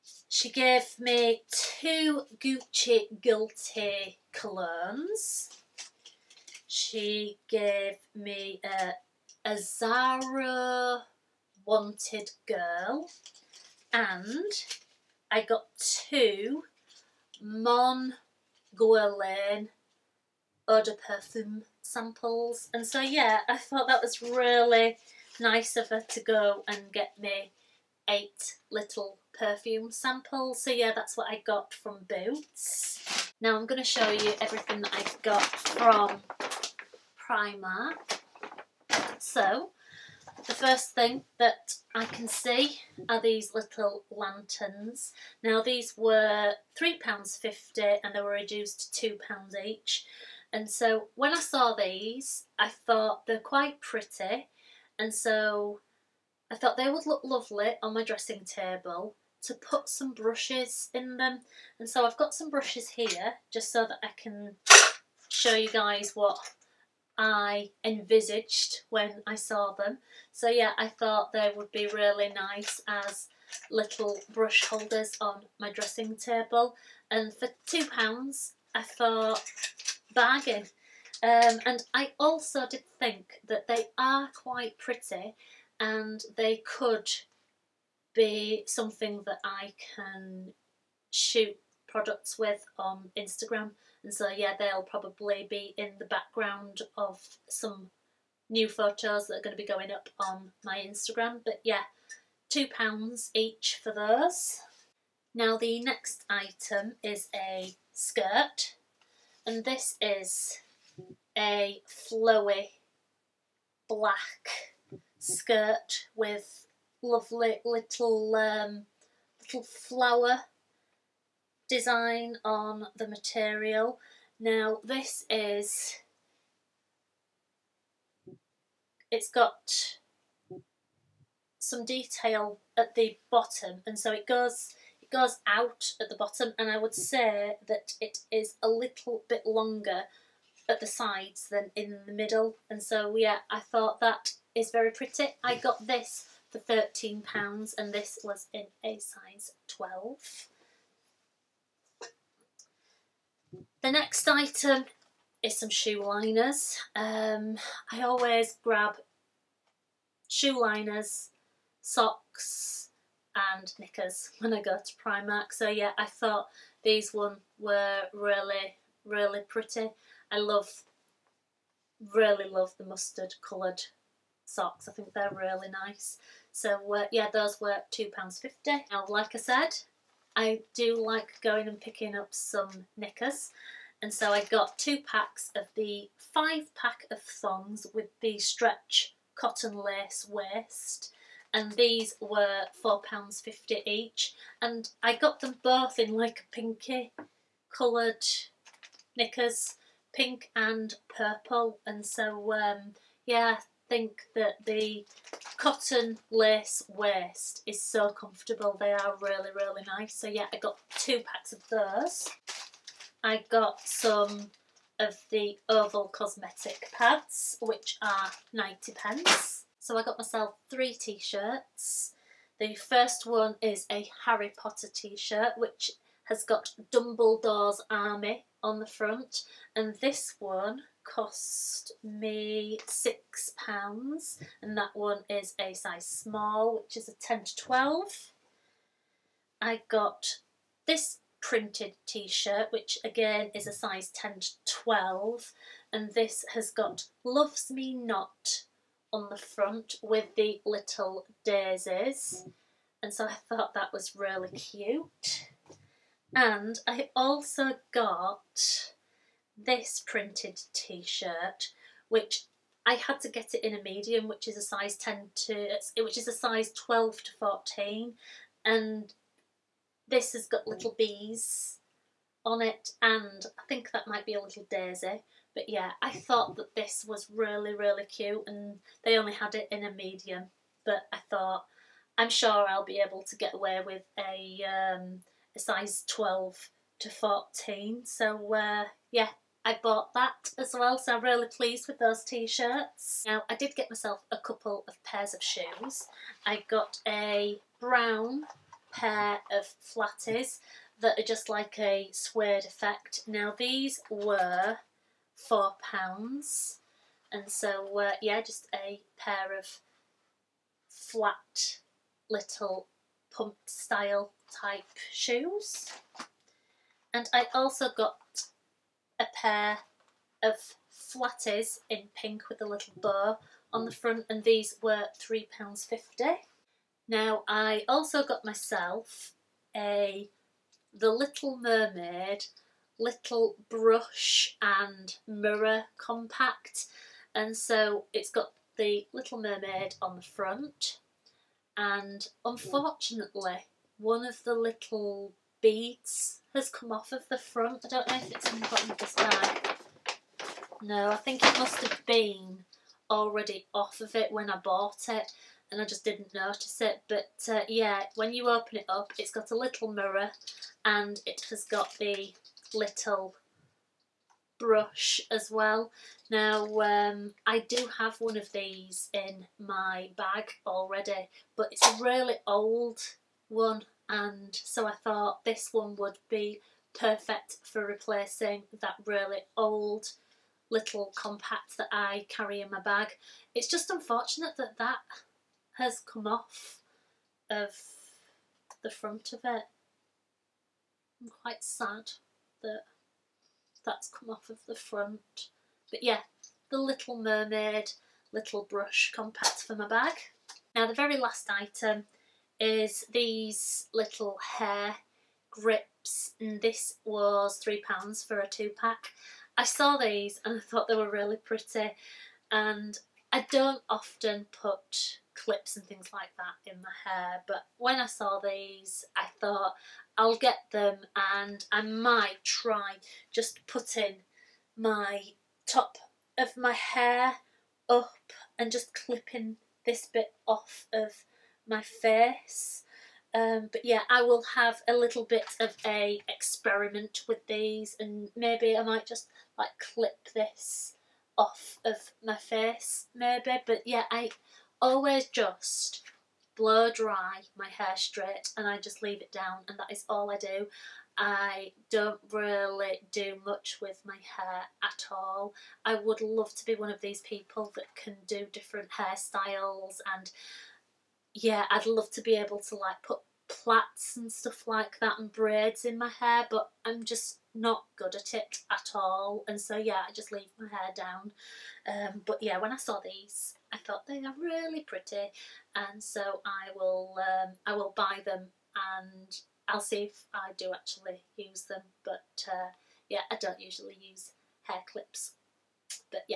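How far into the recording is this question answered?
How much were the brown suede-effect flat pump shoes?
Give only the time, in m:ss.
5:03.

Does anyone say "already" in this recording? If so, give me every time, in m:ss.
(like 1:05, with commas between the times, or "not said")
5:53, 6:10.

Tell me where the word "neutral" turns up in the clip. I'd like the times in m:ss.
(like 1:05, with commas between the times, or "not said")
not said.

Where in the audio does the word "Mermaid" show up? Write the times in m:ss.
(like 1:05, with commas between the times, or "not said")
5:31, 5:39, 6:37.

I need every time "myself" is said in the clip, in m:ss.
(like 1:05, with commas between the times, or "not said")
3:40, 4:53, 5:28.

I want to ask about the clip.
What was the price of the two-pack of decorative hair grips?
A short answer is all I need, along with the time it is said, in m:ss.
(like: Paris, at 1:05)
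£3, at 6:47.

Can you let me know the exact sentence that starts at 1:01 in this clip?
And so I've got some brushes here just so that I can show you guys what I envisaged when I saw them.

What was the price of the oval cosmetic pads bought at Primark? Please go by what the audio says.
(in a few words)
90 pence.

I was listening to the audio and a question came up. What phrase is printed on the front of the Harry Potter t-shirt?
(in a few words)
Dumbledore's Army.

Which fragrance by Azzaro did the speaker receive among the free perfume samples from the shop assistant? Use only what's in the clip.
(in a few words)
Wanted Girl.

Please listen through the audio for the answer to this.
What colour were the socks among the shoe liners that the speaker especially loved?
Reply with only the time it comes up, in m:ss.
2:52.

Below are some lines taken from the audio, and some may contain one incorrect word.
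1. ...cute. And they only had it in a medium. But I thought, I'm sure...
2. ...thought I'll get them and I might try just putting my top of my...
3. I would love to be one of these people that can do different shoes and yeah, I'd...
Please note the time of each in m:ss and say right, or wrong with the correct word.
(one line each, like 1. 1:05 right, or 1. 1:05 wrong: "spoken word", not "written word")
1. 4:38 right
2. 6:59 right
3. 7:35 wrong: "hairstyles", not "shoes".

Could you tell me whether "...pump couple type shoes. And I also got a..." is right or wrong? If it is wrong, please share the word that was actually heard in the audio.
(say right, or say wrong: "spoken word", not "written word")
wrong: "style", not "couple".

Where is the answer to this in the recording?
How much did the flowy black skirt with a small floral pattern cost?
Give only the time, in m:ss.
2:25.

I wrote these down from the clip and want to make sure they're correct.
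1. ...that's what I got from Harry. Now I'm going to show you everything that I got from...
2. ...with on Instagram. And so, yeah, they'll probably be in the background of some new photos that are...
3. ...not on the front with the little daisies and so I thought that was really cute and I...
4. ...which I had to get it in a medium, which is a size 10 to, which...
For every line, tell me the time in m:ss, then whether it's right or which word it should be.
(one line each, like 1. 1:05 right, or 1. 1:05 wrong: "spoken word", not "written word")
1. 0:30 wrong: "Boots", not "Harry"
2. 1:32 right
3. 4:07 right
4. 4:22 right.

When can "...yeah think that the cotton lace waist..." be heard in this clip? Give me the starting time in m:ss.
3:23.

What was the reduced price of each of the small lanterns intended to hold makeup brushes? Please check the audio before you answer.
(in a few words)
£2.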